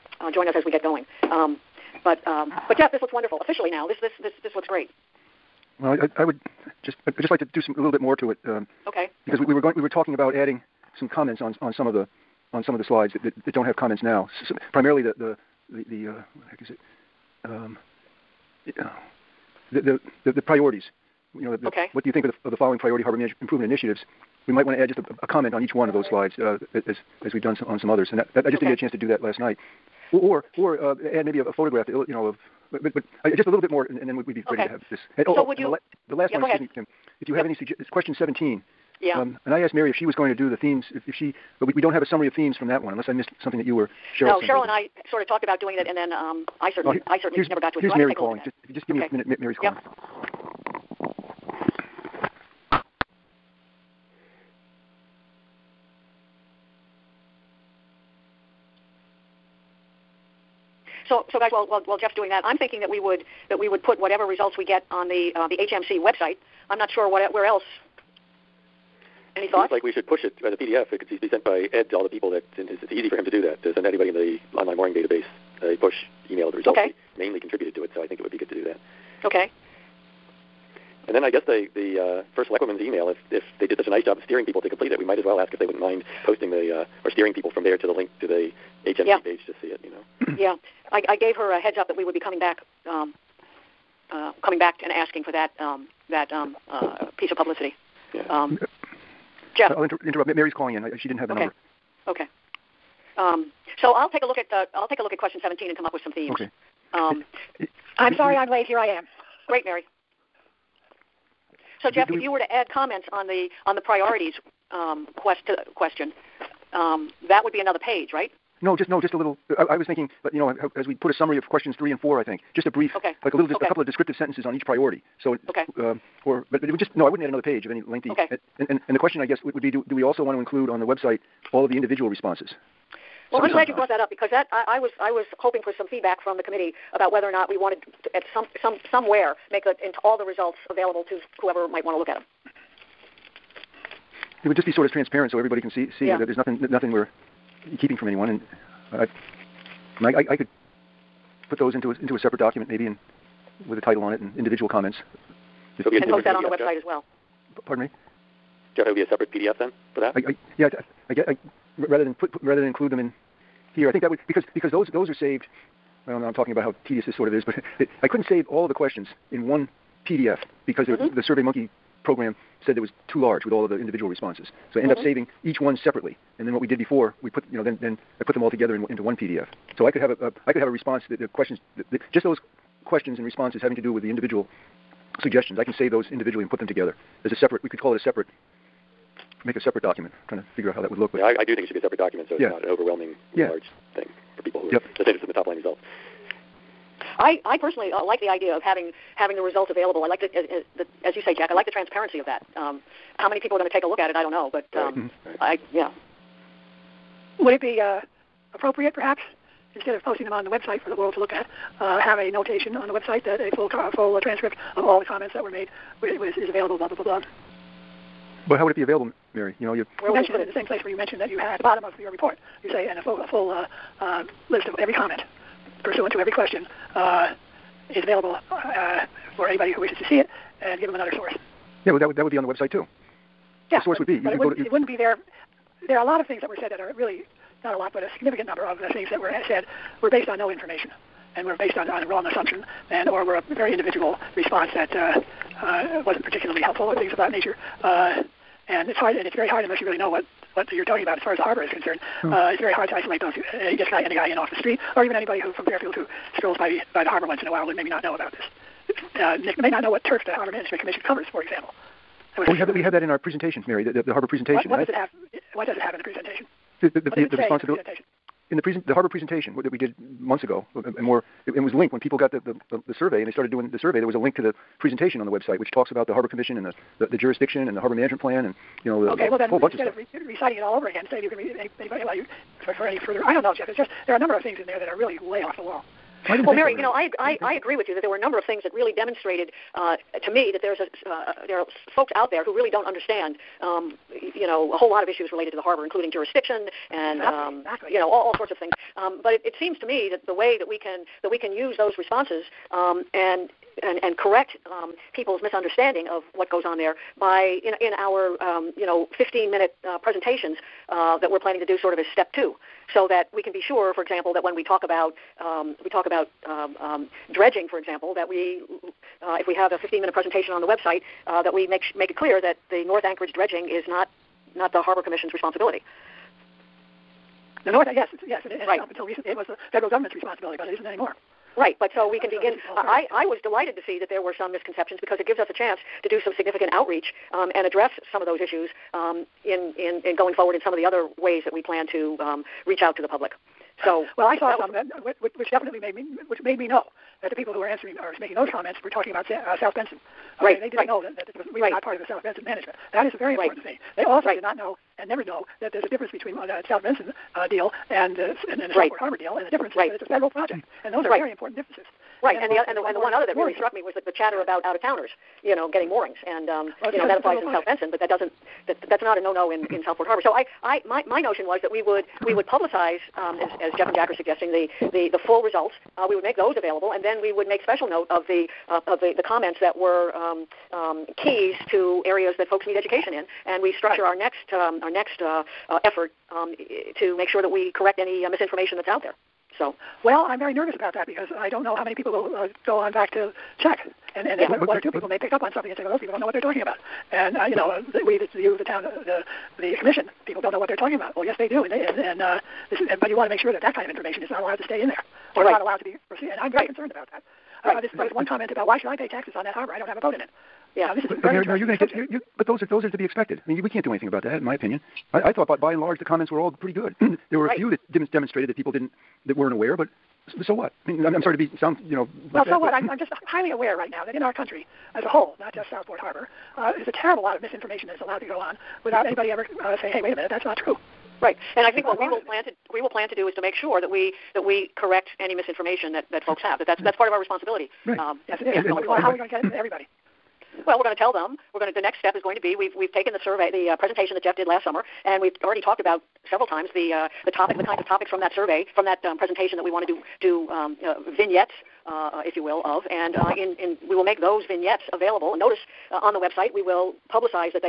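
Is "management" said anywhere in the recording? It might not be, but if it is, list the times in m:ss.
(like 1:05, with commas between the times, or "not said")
0:23, 4:20, 4:37, 5:52.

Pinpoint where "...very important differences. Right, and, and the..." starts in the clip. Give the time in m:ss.
6:01.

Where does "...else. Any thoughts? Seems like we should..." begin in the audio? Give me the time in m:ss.
1:07.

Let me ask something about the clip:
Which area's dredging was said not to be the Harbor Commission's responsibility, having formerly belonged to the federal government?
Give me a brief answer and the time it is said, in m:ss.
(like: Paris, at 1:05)
North Anchorage, at 5:22.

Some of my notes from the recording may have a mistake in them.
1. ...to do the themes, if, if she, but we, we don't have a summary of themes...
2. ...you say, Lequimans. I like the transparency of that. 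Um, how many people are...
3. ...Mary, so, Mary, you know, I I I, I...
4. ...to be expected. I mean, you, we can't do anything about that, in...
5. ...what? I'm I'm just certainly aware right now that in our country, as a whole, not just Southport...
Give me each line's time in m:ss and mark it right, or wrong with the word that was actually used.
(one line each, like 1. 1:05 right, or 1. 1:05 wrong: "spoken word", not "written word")
1. 0:40 right
2. 3:21 wrong: "Jack", not "Lequimans"
3. 4:46 right
4. 6:52 right
5. 7:02 wrong: "highly", not "certainly".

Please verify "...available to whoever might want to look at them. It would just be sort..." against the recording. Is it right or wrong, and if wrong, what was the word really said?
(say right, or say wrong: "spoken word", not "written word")
right.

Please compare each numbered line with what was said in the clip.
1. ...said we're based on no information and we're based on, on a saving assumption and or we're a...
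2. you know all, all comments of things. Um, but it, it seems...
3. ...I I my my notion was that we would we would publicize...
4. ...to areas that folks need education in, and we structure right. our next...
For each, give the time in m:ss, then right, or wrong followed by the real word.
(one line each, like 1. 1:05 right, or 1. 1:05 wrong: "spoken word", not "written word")
1. 3:59 wrong: "wrong", not "saving"
2. 4:57 wrong: "sorts", not "comments"
3. 6:10 right
4. 6:21 right.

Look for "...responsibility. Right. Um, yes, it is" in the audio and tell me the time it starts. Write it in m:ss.
7:17.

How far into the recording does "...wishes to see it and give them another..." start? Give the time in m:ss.
3:49.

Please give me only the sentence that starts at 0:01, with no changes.
Um, but um, but Jeff, this looks wonderful.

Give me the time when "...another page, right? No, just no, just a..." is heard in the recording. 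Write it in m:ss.
1:57.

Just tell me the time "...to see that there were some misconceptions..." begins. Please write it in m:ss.
5:33.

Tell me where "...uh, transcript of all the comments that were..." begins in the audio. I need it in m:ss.
3:34.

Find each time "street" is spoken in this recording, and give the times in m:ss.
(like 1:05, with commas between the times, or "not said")
4:14.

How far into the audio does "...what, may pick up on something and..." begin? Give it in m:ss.
6:35.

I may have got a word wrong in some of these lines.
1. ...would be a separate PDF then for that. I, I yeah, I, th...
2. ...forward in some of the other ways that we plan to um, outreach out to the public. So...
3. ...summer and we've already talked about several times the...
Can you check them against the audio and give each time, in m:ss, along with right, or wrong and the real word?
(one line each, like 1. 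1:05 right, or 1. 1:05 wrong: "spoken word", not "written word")
1. 2:38 right
2. 5:40 wrong: "reach", not "outreach"
3. 7:24 right.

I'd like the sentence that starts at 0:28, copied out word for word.
And that, that I just okay.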